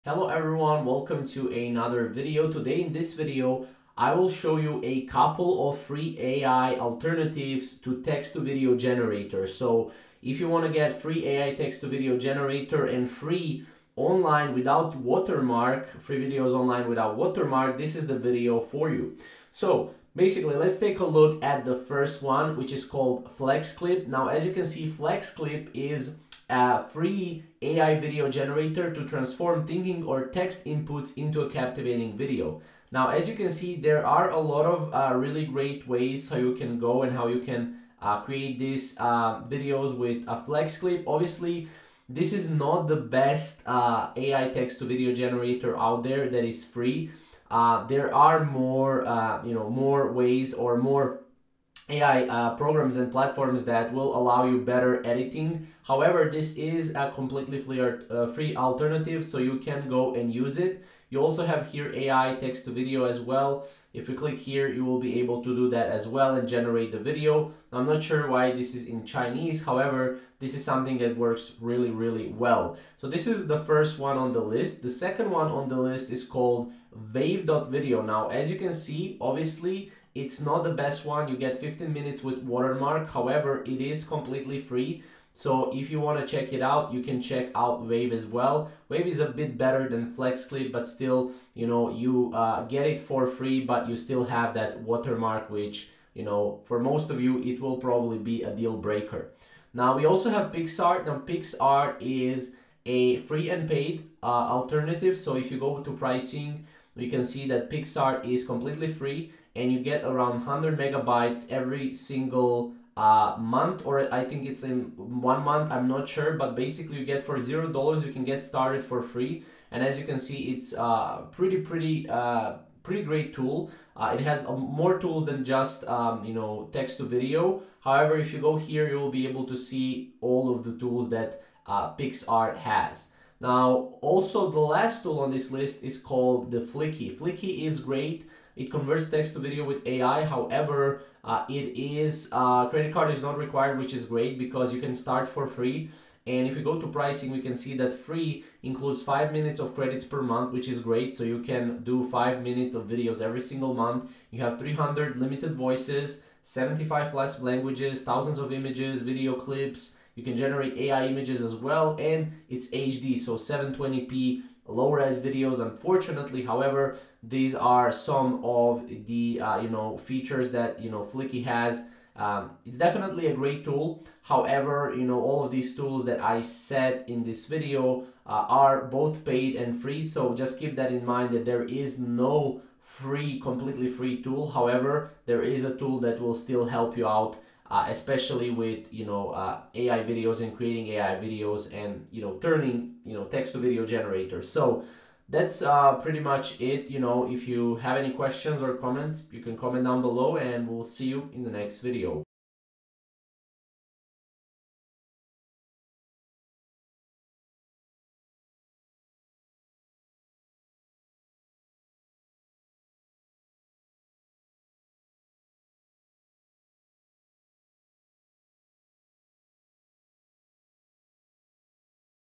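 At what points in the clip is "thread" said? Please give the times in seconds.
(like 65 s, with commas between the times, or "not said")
not said.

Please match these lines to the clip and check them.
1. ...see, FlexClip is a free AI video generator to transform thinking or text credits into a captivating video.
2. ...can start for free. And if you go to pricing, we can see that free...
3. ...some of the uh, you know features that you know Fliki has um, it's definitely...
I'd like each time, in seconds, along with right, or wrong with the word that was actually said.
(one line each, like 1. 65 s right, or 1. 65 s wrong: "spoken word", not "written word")
1. 24 s wrong: "inputs", not "credits"
2. 144 s right
3. 167 s right.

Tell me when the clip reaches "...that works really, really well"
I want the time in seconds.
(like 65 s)
70 s.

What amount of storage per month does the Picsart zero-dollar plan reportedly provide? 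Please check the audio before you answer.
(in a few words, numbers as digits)
100 megabytes.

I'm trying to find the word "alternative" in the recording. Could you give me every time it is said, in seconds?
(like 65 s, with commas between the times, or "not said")
6 s, 58 s, 104 s.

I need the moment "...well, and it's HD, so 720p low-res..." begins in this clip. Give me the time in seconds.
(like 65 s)
161 s.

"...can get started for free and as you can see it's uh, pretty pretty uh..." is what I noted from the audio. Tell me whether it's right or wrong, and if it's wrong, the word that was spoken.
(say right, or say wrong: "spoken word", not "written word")
right.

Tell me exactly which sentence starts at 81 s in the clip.
You get 15 minutes with watermark.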